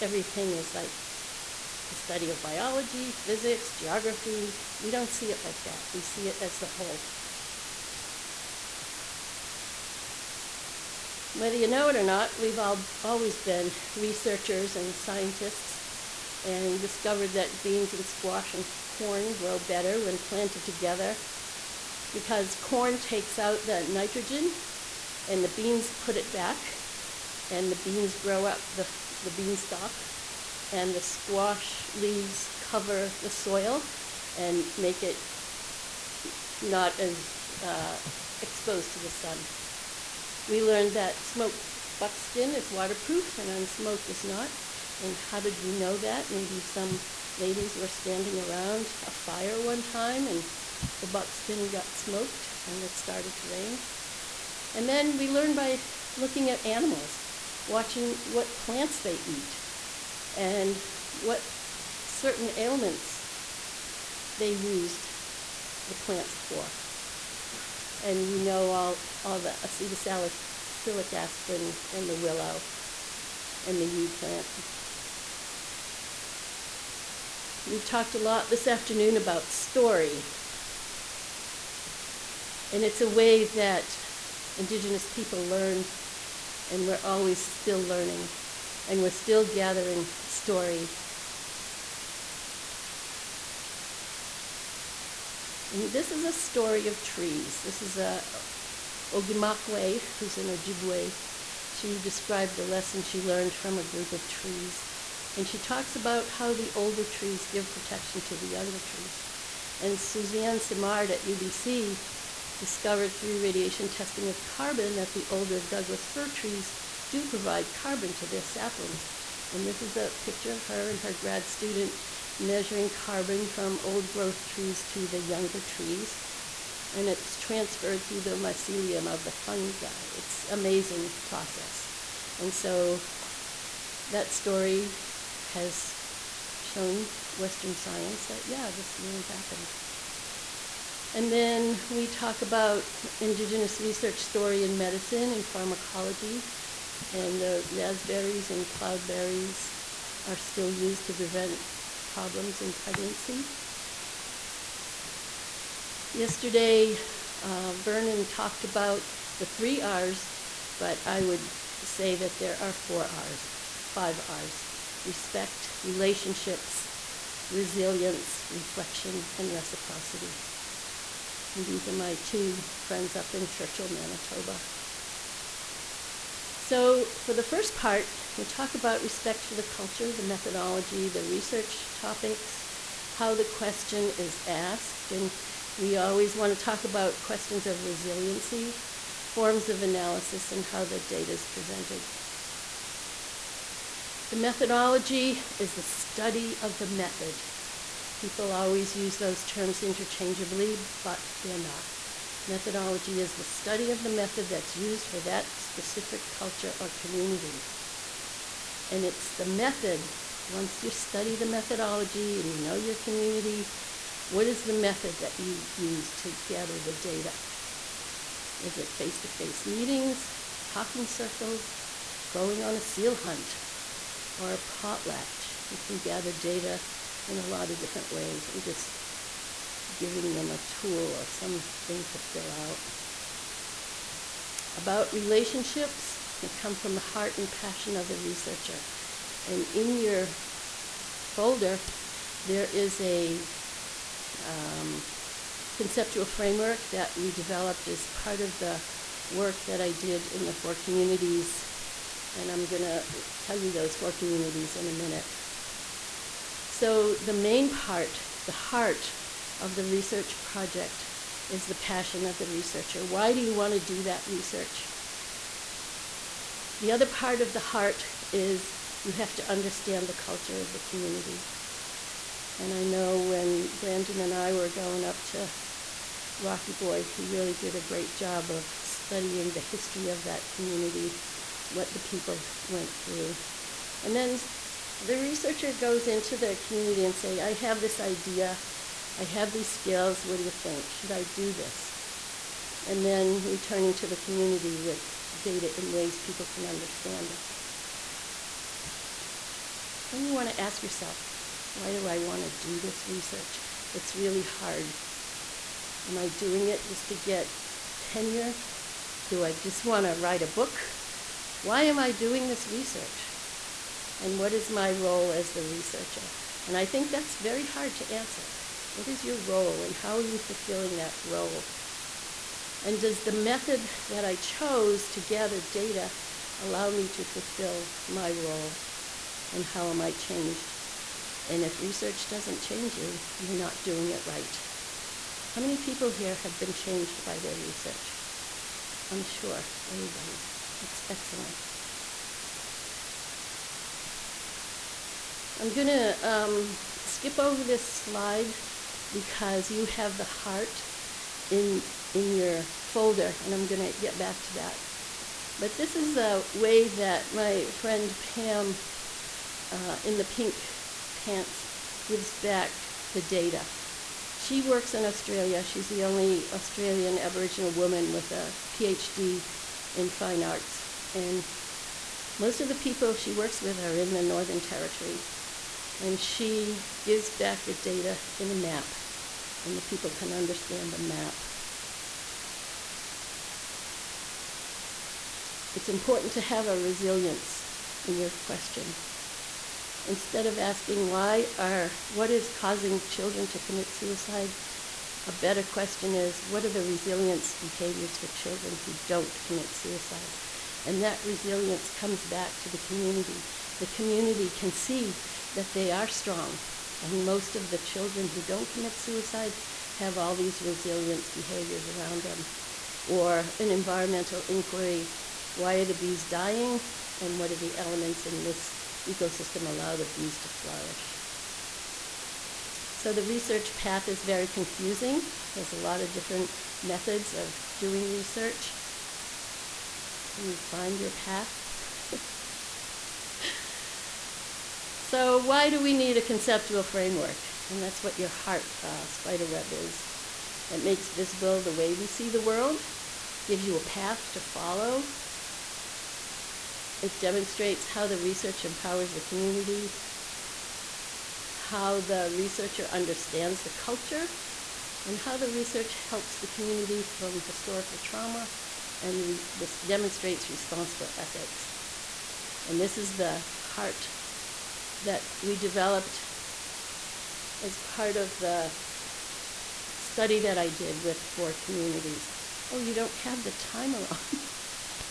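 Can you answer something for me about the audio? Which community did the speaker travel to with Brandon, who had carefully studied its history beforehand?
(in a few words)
Rocky Boy.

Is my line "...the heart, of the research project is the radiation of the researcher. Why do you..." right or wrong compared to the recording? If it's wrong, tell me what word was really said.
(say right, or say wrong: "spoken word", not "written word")
wrong: "passion", not "radiation".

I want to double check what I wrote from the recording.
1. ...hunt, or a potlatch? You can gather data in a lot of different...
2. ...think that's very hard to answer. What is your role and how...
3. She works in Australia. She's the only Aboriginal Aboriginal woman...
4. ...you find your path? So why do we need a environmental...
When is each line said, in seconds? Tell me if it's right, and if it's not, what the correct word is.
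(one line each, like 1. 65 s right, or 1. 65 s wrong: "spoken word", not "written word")
1. 223 s right
2. 316 s right
3. 364 s wrong: "Australian", not "Aboriginal"
4. 430 s wrong: "conceptual", not "environmental".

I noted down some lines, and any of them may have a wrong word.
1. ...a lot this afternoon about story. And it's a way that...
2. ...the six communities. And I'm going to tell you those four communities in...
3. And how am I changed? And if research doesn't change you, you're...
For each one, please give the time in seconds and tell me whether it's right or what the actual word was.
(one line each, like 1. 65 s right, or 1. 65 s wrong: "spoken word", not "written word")
1. 78 s right
2. 250 s wrong: "four", not "six"
3. 329 s right.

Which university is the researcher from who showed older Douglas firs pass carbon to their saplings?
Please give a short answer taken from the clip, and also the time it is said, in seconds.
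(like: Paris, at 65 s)
UBC, at 111 s.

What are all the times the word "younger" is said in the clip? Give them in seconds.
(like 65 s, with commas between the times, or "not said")
108 s, 125 s.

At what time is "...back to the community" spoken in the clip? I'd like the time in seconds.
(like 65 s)
402 s.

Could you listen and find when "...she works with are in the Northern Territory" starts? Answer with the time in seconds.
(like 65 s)
373 s.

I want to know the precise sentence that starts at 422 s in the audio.
So the research path is very confusing.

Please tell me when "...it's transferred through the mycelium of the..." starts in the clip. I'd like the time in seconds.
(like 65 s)
127 s.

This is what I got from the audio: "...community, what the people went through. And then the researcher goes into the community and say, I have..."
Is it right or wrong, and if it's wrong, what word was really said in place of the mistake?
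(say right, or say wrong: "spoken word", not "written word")
right.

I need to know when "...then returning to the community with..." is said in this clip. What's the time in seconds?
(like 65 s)
293 s.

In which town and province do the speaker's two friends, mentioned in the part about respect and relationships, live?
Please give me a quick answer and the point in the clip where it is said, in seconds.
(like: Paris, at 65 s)
Churchill, Manitoba, at 173 s.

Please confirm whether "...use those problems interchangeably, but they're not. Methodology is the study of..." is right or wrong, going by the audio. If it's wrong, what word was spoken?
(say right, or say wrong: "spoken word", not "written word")
wrong: "terms", not "problems".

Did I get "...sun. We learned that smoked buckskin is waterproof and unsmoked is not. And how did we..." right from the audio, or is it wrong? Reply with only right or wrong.
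right.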